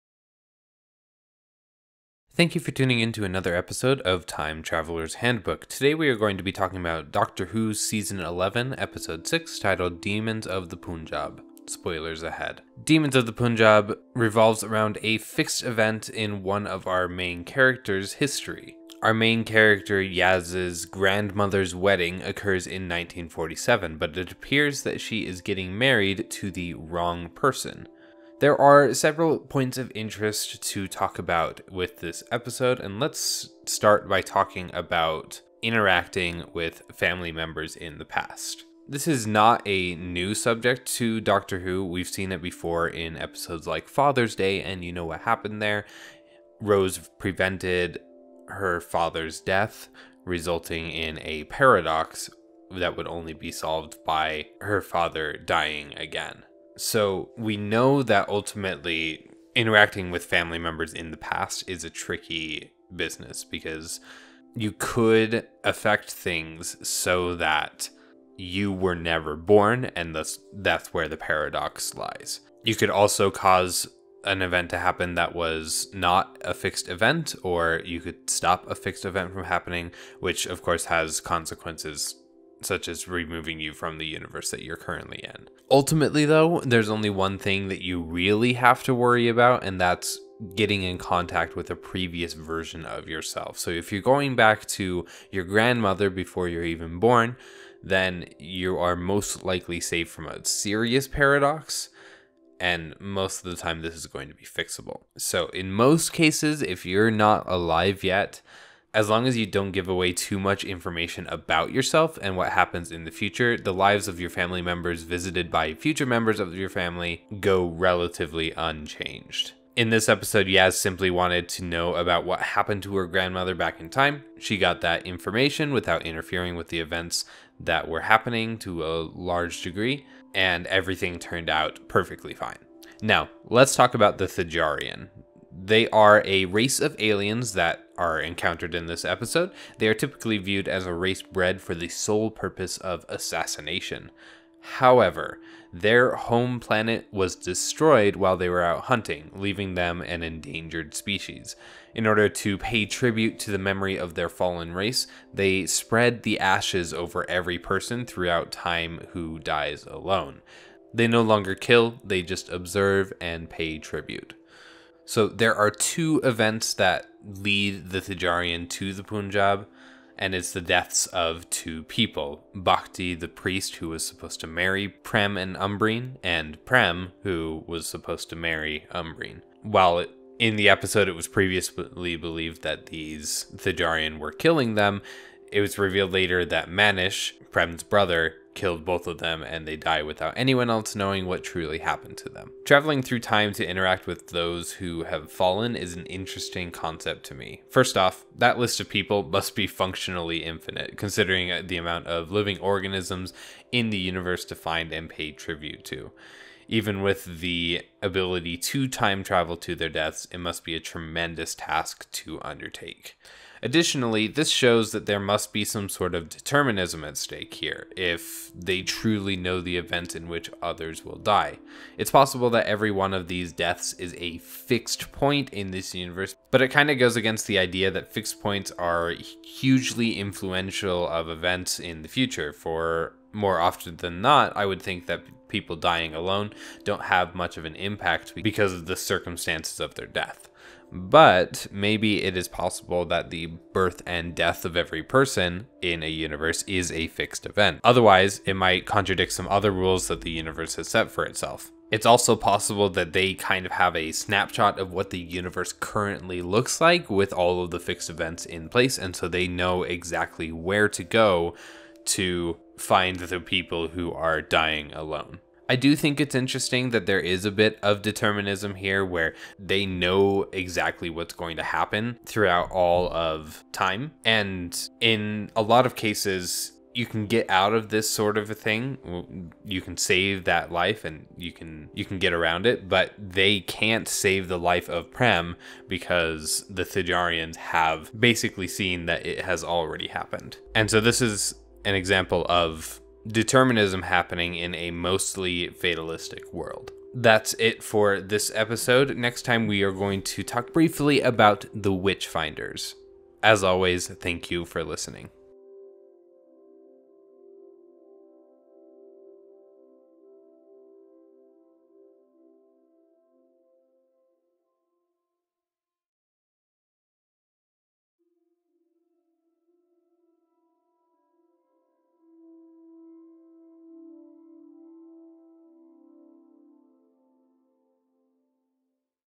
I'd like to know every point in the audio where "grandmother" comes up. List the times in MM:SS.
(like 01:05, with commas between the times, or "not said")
00:20, 01:35, 02:03.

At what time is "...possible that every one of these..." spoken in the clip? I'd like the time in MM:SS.
03:42.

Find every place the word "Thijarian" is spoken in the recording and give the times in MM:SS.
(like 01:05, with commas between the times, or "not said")
02:14, 02:47, 03:03, 04:46.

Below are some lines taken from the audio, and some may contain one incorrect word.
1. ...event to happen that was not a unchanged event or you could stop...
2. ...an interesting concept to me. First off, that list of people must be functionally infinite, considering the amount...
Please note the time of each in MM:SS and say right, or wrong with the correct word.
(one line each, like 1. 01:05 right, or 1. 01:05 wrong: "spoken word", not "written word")
1. 01:14 wrong: "fixed", not "unchanged"
2. 03:15 right.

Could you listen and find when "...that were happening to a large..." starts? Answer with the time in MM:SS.
02:07.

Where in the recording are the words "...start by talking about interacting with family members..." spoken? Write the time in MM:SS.
00:33.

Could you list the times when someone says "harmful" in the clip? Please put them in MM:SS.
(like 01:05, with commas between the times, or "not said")
not said.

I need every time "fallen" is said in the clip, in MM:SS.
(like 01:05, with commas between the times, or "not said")
02:34, 03:15.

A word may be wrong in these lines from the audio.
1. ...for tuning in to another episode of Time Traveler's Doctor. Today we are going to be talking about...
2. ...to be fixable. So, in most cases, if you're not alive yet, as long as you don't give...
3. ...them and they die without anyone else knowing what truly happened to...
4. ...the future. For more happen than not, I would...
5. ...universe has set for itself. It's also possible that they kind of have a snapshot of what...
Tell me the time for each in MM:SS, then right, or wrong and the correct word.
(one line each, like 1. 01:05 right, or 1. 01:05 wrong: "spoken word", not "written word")
1. 00:02 wrong: "Handbook", not "Doctor"
2. 01:44 right
3. 03:09 right
4. 03:52 wrong: "often", not "happen"
5. 04:10 right.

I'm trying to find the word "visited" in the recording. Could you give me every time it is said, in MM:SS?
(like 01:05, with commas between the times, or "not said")
01:55.